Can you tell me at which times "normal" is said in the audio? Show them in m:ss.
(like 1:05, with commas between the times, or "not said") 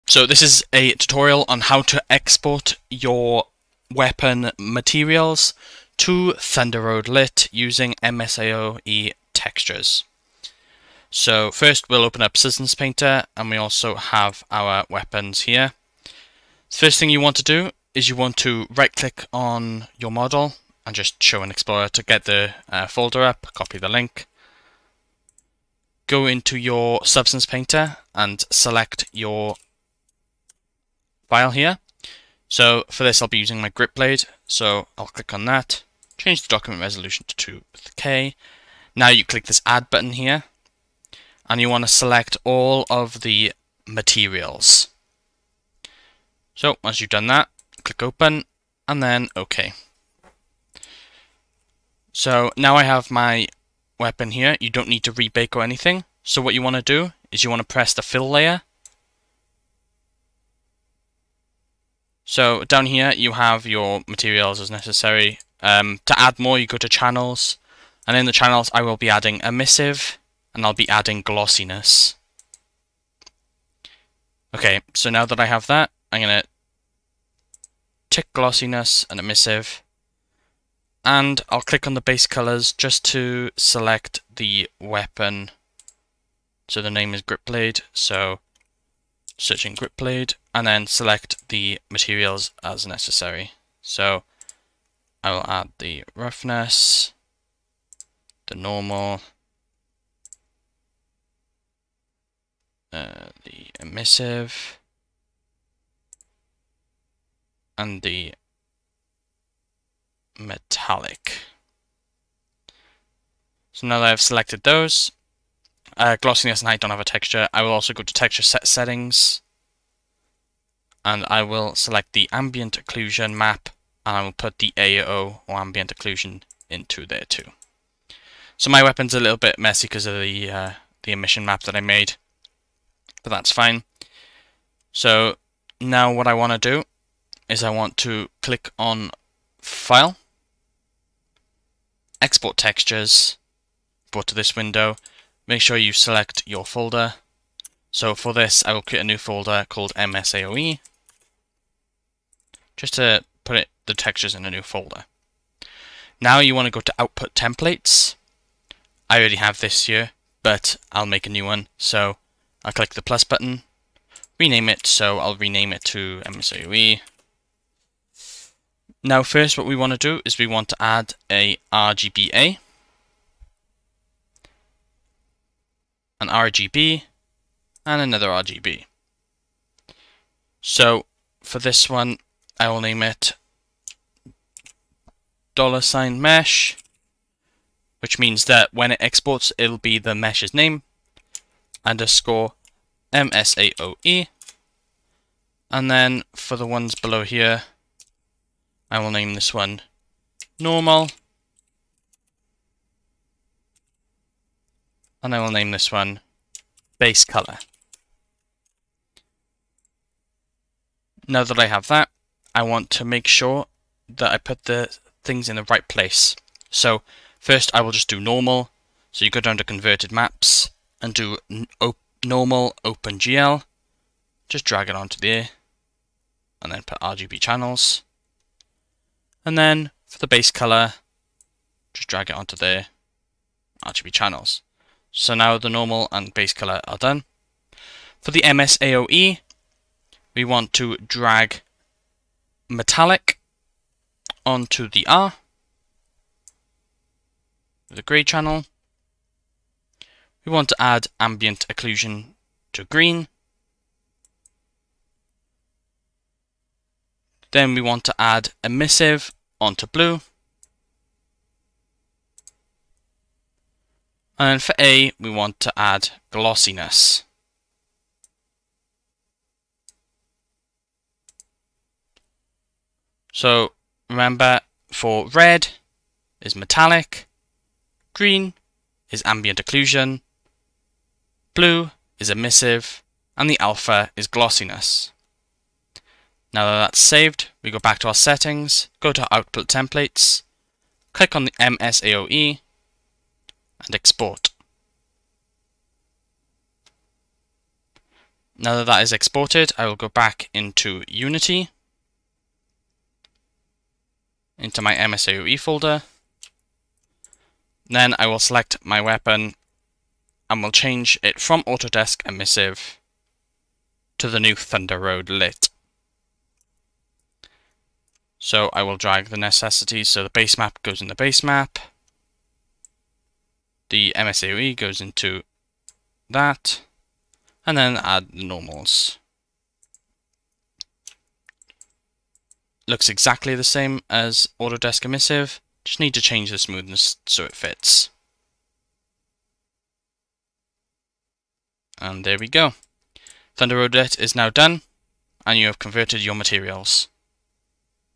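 1:38, 3:20, 3:38, 3:42, 3:55, 5:28.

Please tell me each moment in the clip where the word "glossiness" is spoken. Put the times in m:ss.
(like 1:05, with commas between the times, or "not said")
1:11, 1:18, 1:56, 4:26, 4:44.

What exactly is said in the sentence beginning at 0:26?
Go into your Substance Painter and select your file here.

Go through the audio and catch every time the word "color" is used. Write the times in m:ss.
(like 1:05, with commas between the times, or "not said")
1:22, 3:27, 3:50, 3:56.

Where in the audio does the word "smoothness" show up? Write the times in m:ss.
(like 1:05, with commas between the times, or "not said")
5:36.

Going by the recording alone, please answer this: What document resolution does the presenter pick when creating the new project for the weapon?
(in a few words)
2K.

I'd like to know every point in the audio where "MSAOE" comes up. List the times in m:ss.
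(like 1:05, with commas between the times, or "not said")
0:08, 2:29, 2:46, 3:13, 3:58, 4:51, 5:04, 5:24.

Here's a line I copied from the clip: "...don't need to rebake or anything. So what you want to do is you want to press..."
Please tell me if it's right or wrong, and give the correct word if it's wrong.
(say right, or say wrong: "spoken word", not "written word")
right.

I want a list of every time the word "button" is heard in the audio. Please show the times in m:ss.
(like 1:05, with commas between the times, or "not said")
0:39, 2:43.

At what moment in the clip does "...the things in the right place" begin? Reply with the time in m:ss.
3:34.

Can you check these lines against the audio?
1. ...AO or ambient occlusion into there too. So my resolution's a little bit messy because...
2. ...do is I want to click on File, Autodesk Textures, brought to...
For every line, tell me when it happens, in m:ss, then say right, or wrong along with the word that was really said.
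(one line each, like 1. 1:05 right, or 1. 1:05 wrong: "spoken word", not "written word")
1. 2:04 wrong: "weapon", not "resolution"
2. 2:16 wrong: "Export", not "Autodesk".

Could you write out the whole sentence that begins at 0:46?
So once you've done that, click open and then OK.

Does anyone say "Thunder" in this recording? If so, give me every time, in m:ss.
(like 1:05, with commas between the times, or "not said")
0:06, 5:14, 5:43.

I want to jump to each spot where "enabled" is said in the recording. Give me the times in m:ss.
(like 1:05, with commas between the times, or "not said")
not said.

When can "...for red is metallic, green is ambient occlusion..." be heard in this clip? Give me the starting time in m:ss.
4:34.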